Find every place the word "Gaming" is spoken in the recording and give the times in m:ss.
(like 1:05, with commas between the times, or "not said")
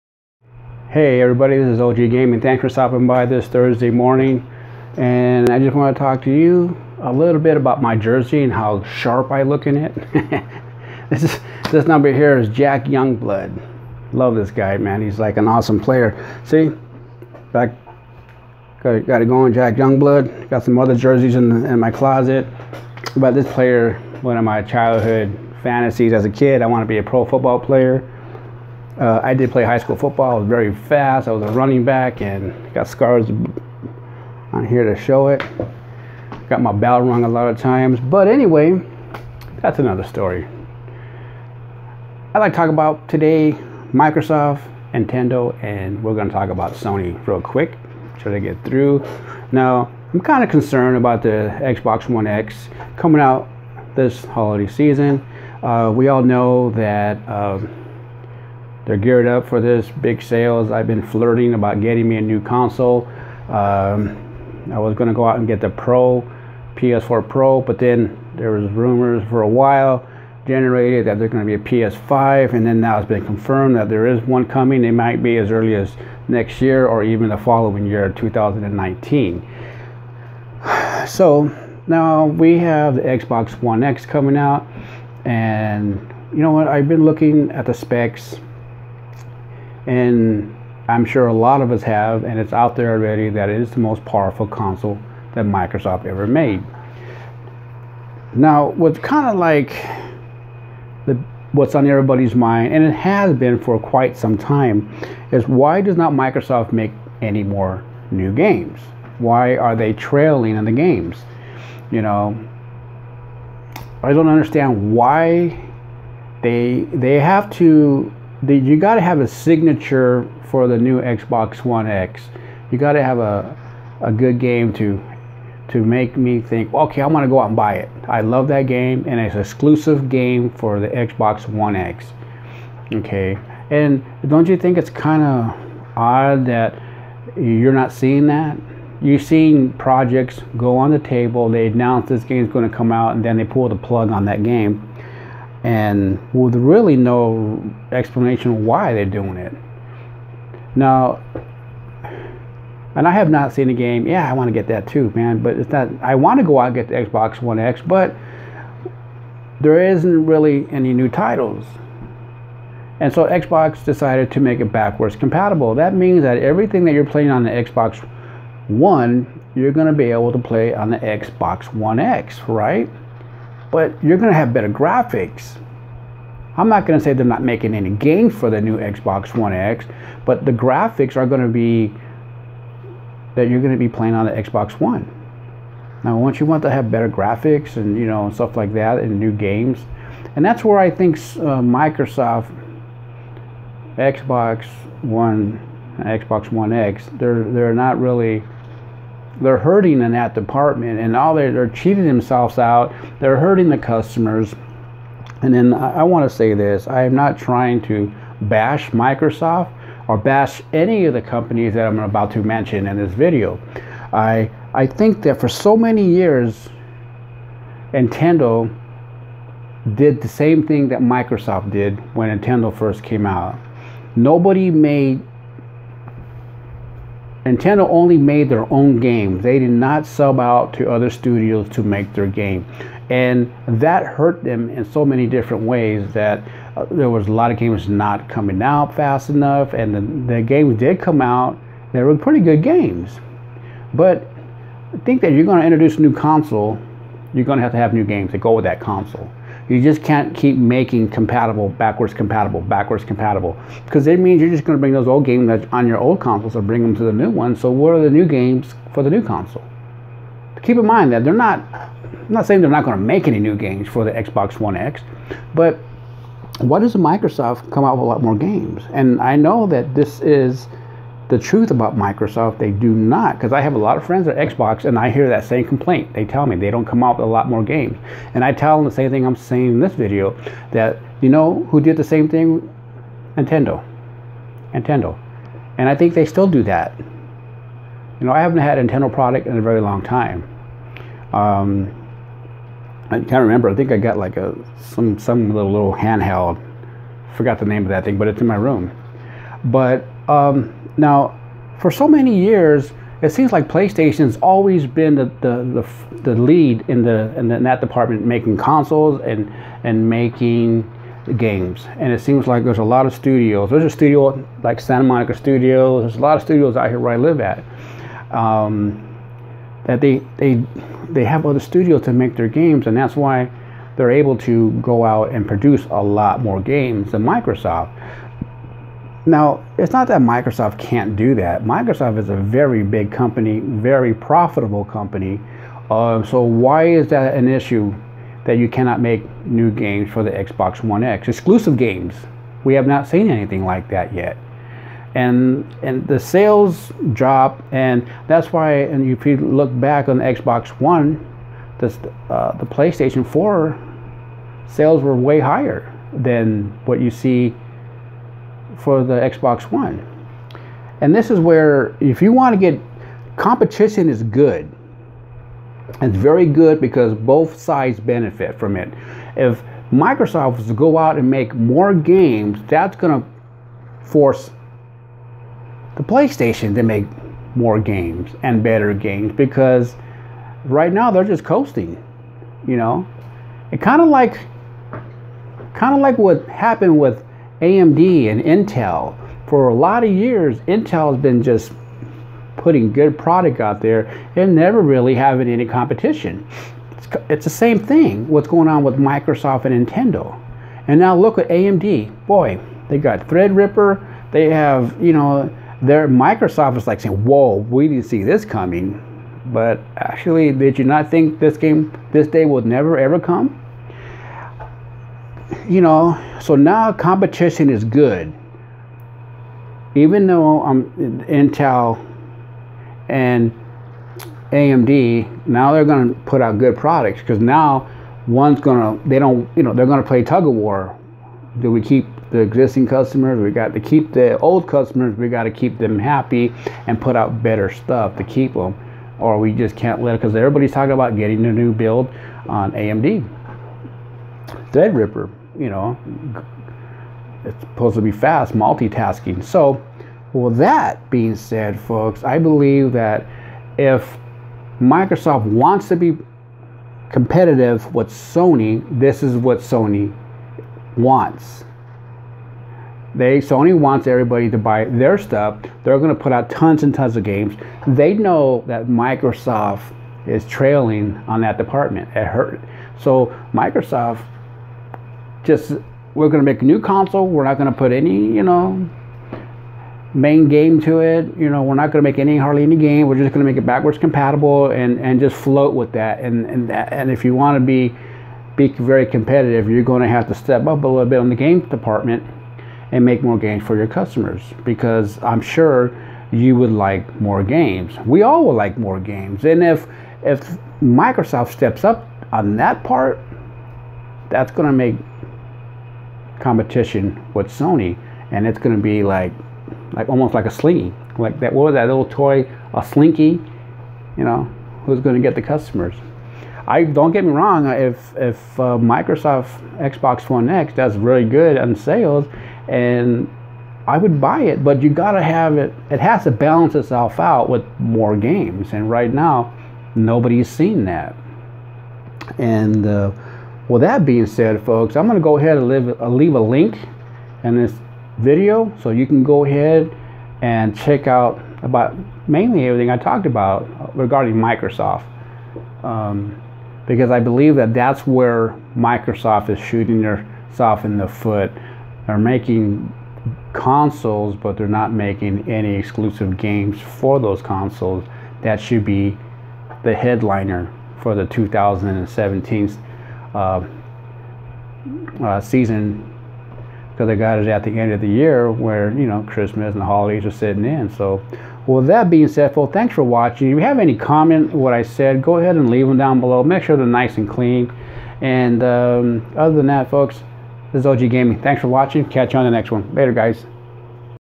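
0:02, 9:41.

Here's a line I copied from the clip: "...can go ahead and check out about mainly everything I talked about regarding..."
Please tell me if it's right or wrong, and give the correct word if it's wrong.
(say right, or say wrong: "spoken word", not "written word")
right.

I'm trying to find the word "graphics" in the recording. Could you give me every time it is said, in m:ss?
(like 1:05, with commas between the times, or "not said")
2:54, 3:00, 3:07.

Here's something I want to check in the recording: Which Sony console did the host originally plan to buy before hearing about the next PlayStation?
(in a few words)
PS4 Pro.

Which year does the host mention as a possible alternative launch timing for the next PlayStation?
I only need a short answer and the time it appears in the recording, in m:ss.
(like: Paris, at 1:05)
2019, at 1:18.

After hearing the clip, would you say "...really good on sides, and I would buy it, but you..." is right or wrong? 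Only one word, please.
wrong.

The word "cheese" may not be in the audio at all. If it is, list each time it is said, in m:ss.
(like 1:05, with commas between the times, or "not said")
not said.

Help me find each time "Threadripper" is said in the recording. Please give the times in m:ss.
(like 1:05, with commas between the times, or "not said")
6:43, 7:24.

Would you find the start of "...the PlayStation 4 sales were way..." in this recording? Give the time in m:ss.
5:52.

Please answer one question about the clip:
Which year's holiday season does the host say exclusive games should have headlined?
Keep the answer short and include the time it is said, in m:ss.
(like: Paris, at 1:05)
2017, at 9:21.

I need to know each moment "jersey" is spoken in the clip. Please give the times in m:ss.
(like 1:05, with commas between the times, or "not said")
0:07, 0:20.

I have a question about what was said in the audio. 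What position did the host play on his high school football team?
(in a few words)
Running back.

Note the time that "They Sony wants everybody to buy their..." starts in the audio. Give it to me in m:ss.
7:43.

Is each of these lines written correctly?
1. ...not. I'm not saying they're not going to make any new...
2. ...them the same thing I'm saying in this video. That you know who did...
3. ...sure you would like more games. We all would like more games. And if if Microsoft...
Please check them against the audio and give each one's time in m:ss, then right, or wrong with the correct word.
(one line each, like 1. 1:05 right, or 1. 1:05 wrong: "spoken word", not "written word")
1. 4:21 right
2. 4:38 right
3. 8:15 right.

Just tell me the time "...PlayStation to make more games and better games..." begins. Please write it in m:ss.
6:16.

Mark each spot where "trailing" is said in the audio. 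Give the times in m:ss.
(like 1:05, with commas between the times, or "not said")
1:49, 7:50.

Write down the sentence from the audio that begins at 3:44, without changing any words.
Nobody made Nintendo only made their own game.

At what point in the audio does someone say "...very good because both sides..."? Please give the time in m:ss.
6:06.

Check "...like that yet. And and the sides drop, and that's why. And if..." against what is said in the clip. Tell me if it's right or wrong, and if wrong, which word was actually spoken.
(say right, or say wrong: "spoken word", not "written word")
wrong: "sales", not "sides".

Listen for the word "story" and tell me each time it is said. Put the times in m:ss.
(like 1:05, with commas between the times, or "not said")
0:40.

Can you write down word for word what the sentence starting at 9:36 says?
Make sure they're nice and clean.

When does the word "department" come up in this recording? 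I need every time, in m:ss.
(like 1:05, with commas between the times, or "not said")
3:20, 5:07, 7:51, 8:11.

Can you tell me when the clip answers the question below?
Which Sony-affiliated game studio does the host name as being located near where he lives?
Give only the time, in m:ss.
5:14.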